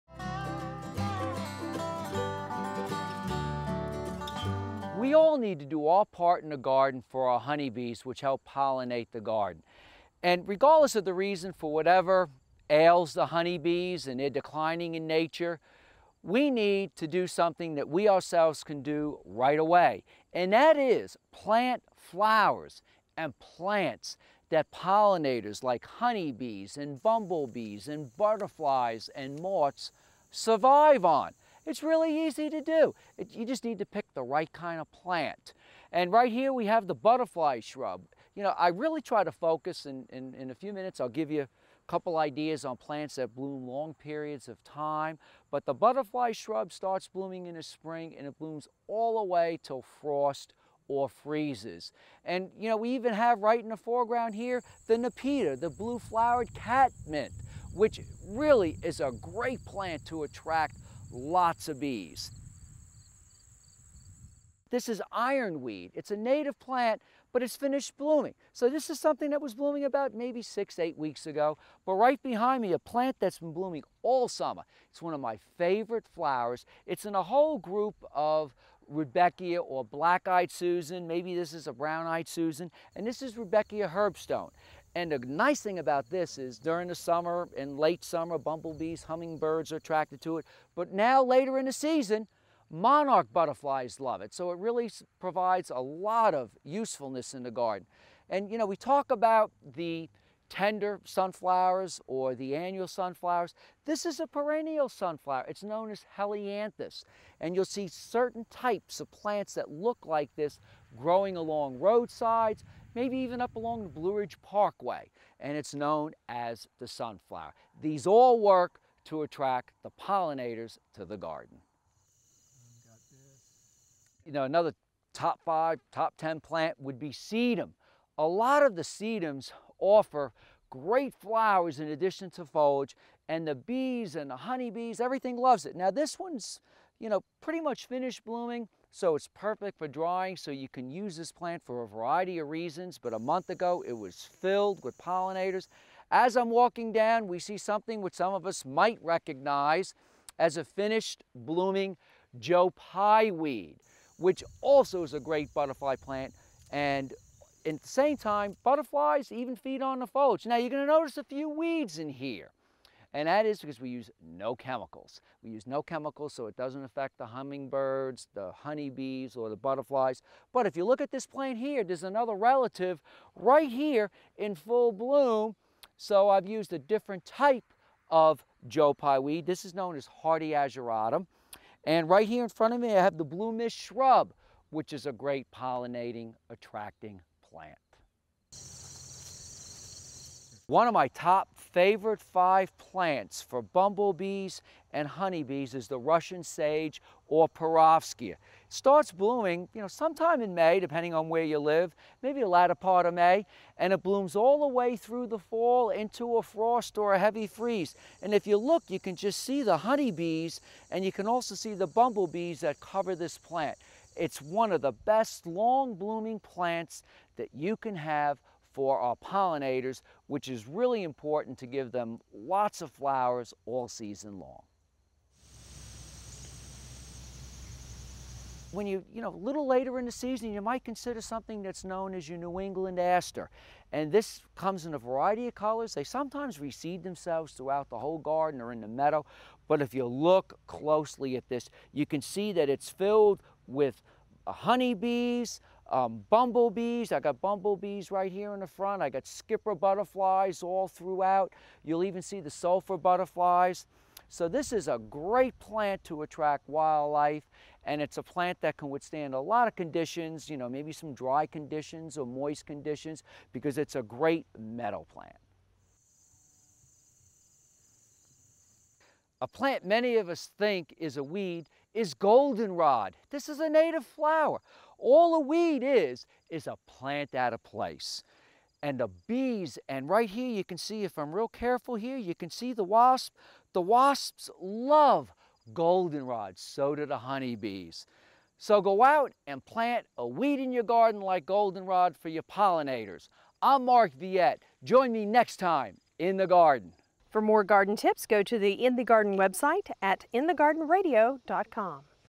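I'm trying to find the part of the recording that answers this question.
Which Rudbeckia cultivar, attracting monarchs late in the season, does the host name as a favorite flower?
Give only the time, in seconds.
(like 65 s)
83 s.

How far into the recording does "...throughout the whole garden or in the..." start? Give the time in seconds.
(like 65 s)
237 s.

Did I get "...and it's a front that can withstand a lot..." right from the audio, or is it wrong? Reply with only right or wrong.
wrong.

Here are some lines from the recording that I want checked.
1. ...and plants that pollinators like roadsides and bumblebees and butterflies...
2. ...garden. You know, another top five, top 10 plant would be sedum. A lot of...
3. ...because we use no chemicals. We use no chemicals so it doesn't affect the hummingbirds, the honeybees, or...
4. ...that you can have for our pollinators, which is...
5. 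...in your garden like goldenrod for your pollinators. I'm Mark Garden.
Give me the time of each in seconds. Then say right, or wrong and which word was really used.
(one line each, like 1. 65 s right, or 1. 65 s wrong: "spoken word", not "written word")
1. 23 s wrong: "honeybees", not "roadsides"
2. 121 s right
3. 163 s right
4. 217 s right
5. 290 s wrong: "Viette", not "Garden".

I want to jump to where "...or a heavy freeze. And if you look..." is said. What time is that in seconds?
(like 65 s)
206 s.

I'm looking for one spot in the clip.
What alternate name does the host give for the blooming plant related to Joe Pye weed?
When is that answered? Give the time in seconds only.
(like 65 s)
180 s.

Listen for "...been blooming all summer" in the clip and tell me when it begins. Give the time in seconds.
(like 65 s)
73 s.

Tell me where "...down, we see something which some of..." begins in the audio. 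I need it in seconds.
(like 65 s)
146 s.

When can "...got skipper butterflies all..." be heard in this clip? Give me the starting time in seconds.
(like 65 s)
249 s.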